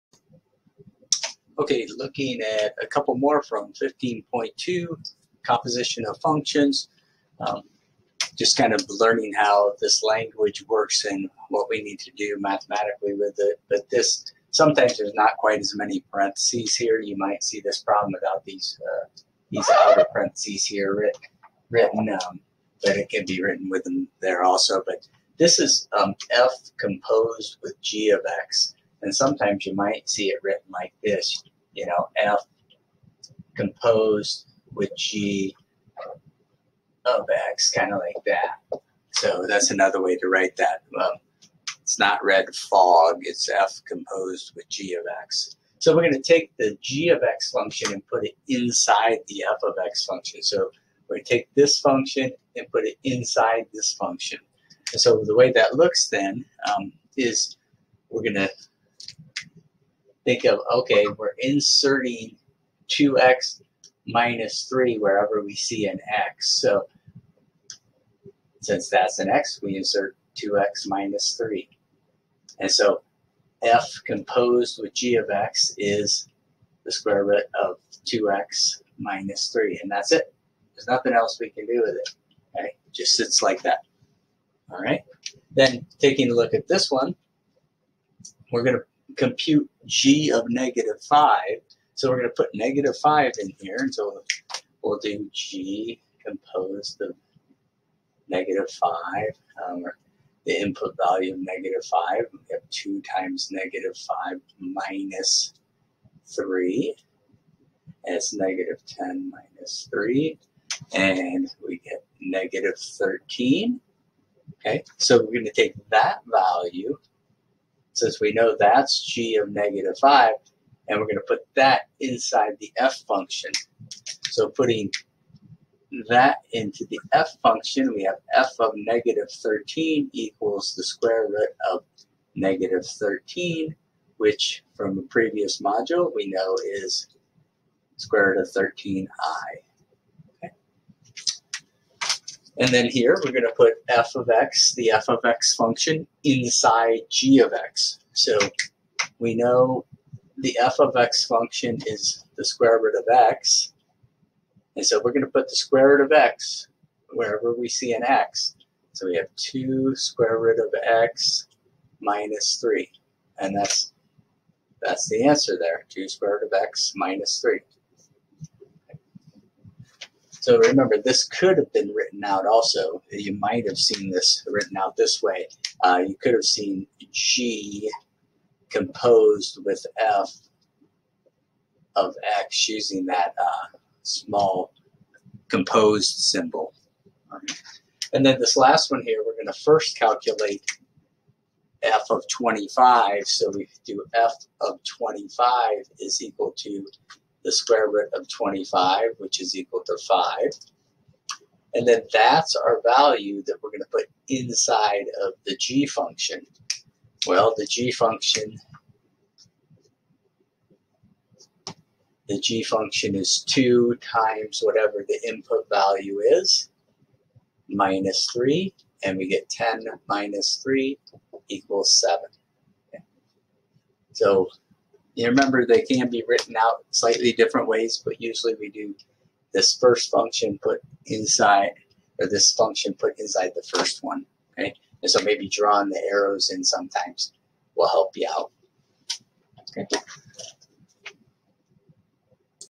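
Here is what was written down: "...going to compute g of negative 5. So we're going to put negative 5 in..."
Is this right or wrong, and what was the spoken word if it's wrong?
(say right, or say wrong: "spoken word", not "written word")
right.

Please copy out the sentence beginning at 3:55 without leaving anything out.
And so maybe drawing the arrows in sometimes will help you out, okay?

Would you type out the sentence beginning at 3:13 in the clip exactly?
So we do f of 25 is equal to the square root of 25, which is equal to 5.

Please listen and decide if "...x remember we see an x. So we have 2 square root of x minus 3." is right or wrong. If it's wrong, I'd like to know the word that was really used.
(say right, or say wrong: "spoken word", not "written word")
wrong: "wherever", not "remember".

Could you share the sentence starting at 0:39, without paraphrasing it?
So that's another way to write that.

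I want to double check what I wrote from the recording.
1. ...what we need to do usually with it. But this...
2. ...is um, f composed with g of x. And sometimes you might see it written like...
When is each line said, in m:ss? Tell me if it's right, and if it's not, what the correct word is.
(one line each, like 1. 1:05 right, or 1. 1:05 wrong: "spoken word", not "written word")
1. 0:11 wrong: "mathematically", not "usually"
2. 0:25 right.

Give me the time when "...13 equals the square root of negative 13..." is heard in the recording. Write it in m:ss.
2:09.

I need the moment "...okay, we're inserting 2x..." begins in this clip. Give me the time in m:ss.
1:00.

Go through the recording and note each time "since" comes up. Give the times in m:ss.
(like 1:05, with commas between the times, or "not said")
1:08, 1:58.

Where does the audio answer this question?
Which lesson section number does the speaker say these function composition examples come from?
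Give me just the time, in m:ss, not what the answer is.
0:03.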